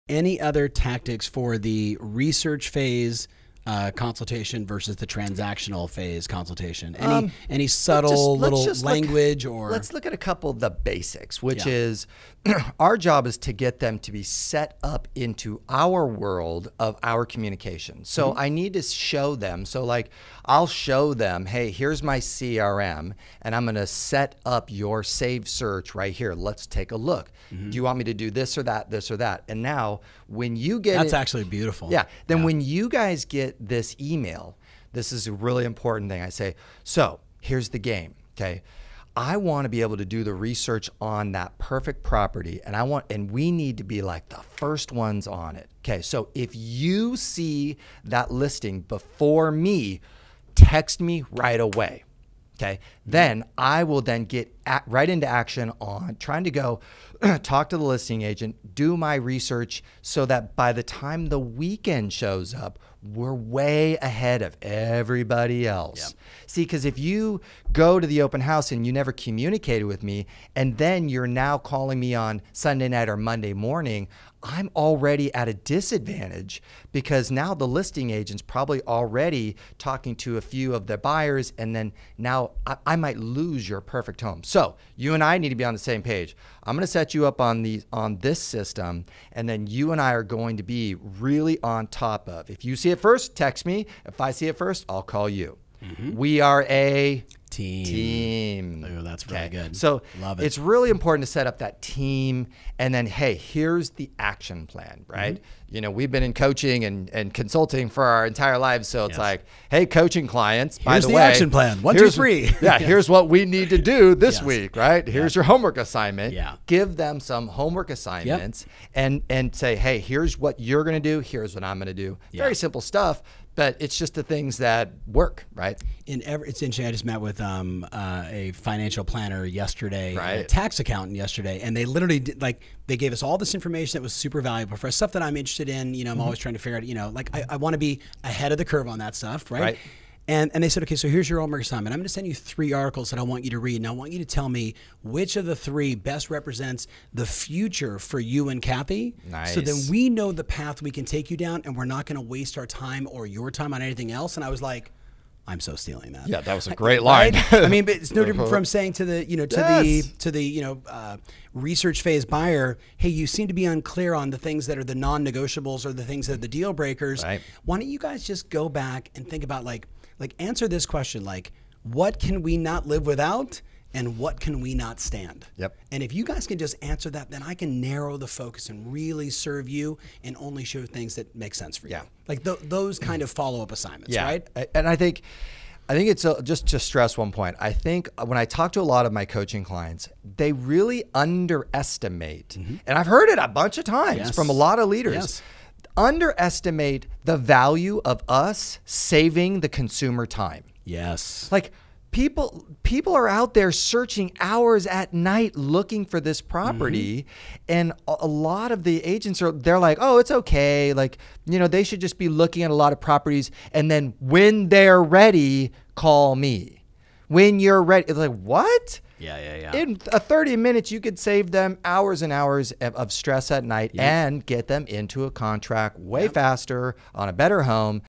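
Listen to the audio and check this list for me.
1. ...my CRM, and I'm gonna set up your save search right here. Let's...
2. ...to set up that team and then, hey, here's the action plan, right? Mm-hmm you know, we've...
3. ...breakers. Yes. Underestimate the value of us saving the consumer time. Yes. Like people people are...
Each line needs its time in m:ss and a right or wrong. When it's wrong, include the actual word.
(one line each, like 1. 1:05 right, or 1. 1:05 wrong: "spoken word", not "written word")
1. 0:22 right
2. 1:41 right
3. 3:14 wrong: "leaders", not "breakers".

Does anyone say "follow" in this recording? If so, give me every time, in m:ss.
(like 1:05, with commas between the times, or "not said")
3:03.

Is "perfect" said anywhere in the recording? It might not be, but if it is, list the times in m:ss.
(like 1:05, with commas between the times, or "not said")
0:41, 1:23.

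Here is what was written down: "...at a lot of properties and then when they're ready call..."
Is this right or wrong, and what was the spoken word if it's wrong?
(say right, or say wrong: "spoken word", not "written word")
right.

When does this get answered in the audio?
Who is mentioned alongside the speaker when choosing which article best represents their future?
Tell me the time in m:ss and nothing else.
2:28.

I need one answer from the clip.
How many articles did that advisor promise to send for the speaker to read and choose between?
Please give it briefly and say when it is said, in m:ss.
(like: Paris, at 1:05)
3, at 2:22.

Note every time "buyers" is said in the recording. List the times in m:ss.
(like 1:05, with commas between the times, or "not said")
1:20, 2:42.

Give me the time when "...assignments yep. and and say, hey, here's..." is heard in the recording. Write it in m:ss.
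1:57.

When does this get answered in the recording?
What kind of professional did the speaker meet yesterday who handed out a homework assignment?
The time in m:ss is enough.
2:10.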